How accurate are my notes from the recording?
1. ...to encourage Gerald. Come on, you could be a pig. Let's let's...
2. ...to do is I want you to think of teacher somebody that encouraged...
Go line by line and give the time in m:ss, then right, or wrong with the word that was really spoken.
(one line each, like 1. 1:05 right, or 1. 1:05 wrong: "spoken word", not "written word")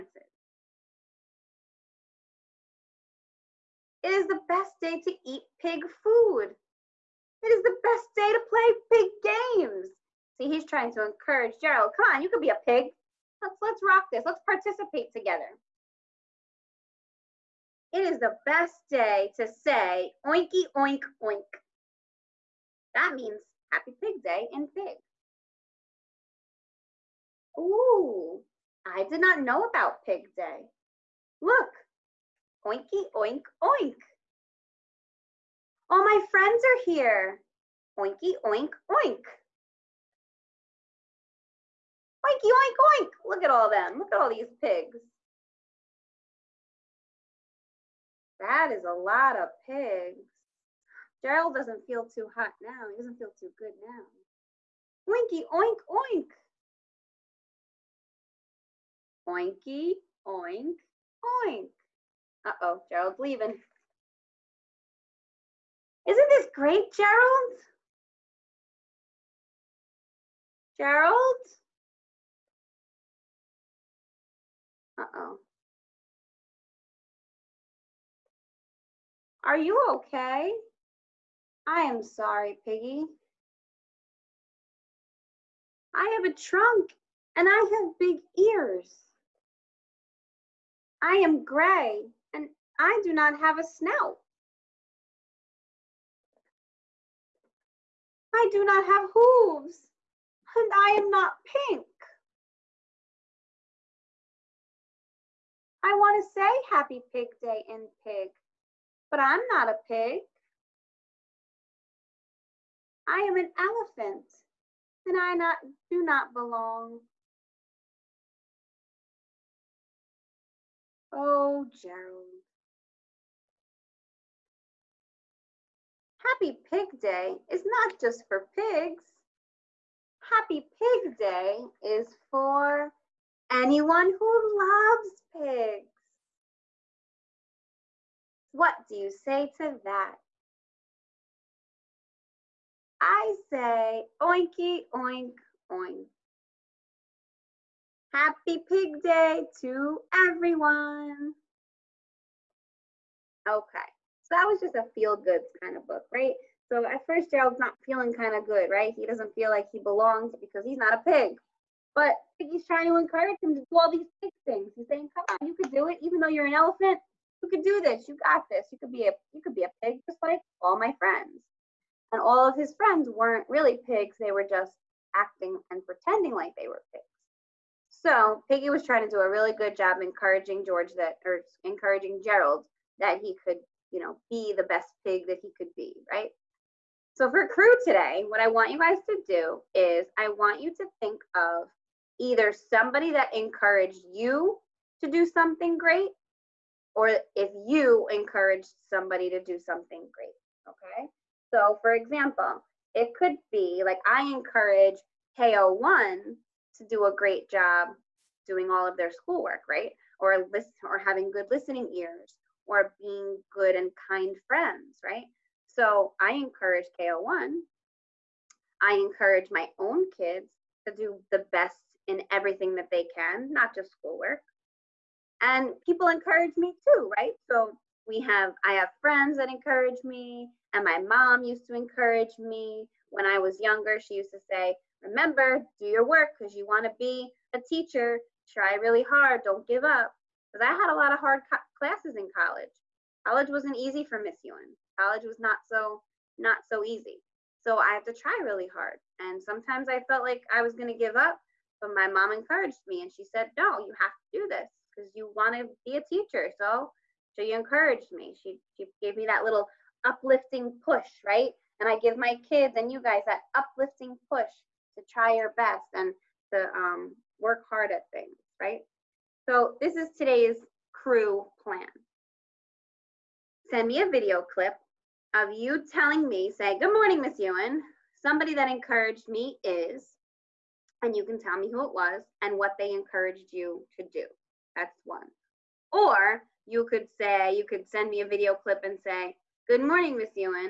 1. 0:10 right
2. 3:09 wrong: "either", not "teacher".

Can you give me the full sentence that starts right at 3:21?
So for example, it could be like I encourage KO1 to do a great job doing all of their schoolwork, right?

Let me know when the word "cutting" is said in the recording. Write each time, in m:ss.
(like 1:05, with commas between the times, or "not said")
not said.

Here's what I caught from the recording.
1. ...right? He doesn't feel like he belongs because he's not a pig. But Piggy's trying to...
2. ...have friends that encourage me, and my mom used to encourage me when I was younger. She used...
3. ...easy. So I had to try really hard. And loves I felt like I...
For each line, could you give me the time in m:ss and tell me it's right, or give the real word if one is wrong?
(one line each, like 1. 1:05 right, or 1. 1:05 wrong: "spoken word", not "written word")
1. 2:38 right
2. 3:48 right
3. 4:06 wrong: "sometimes", not "loves".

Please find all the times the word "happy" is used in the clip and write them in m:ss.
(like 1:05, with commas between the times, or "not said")
0:23, 1:46, 2:06, 2:10, 2:28.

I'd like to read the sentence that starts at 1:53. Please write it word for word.
I am an elephant and I not, do not belong Oh, Gerald.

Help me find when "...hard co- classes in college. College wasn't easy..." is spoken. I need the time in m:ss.
4:01.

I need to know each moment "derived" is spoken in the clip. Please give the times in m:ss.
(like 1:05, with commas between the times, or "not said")
not said.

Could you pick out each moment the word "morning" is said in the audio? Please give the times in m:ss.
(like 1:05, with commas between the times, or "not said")
4:36, 4:49.